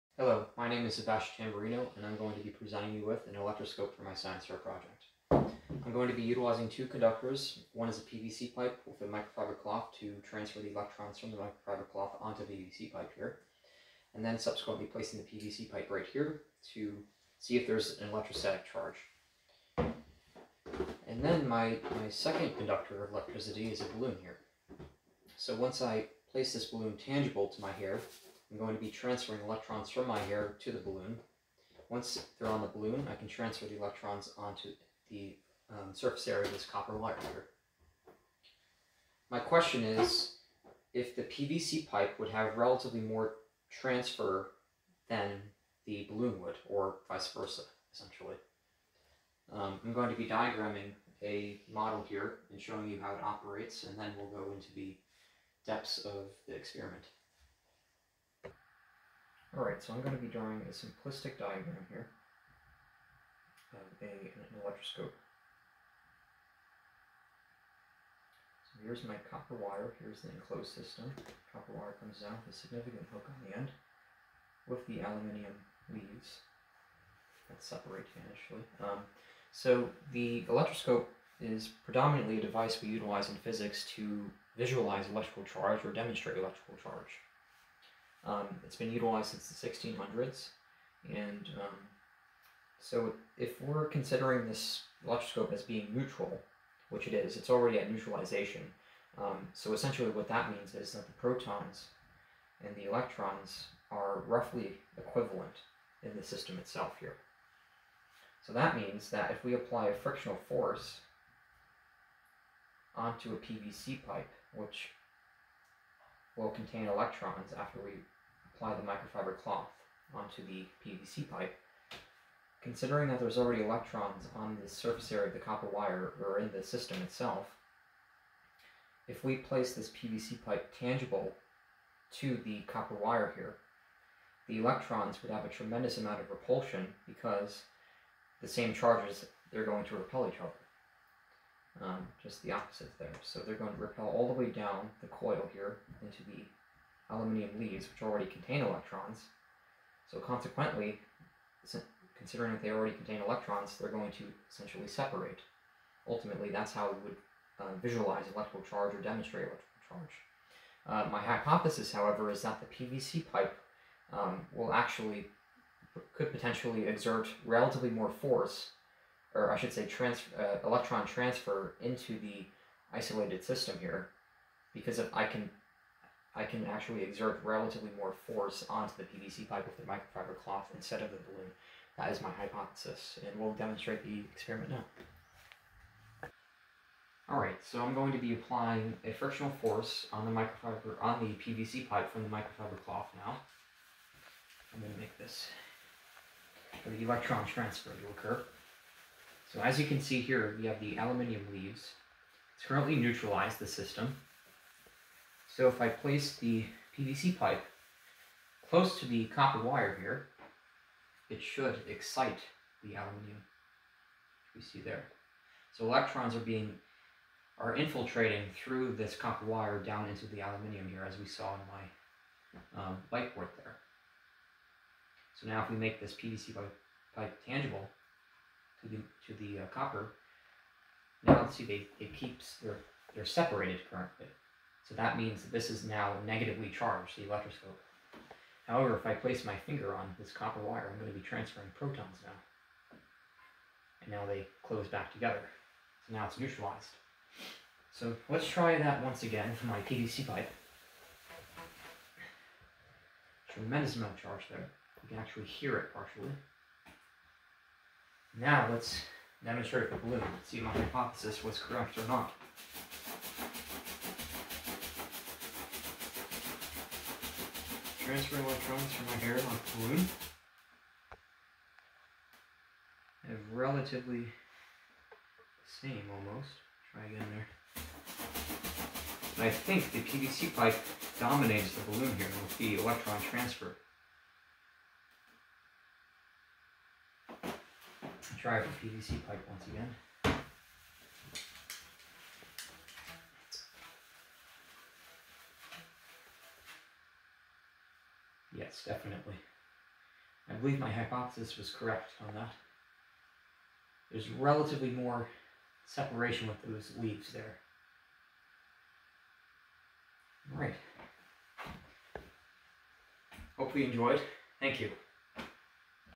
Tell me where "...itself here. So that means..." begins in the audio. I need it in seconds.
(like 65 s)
106 s.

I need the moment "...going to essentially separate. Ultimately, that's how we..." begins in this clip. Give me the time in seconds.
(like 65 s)
153 s.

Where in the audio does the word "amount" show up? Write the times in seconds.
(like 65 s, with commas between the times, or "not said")
135 s, 253 s.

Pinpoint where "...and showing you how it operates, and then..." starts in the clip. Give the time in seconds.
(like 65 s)
52 s.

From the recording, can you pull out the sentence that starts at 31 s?
Once they're on the balloon, I can transfer the electrons onto the um, surface area of this copper wire here.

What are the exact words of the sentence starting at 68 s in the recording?
So here's my copper wire, here's the enclosed system.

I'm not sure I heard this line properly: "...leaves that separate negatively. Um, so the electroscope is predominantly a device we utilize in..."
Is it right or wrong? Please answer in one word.
wrong.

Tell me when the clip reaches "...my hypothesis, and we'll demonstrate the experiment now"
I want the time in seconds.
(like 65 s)
182 s.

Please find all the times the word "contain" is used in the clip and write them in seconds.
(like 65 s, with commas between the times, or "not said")
116 s, 148 s, 152 s.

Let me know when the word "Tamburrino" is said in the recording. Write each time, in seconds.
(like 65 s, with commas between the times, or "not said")
1 s.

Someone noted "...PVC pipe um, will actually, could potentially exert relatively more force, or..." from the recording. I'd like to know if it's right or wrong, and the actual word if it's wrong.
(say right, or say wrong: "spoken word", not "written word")
right.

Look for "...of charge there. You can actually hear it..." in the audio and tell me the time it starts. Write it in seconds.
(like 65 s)
254 s.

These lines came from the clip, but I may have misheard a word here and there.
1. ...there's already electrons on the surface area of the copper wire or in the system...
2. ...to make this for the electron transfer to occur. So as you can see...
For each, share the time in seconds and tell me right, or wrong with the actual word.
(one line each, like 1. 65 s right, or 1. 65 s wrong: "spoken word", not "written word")
1. 123 s right
2. 194 s right.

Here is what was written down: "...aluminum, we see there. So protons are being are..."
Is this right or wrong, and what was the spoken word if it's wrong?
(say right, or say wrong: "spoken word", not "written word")
wrong: "electrons", not "protons".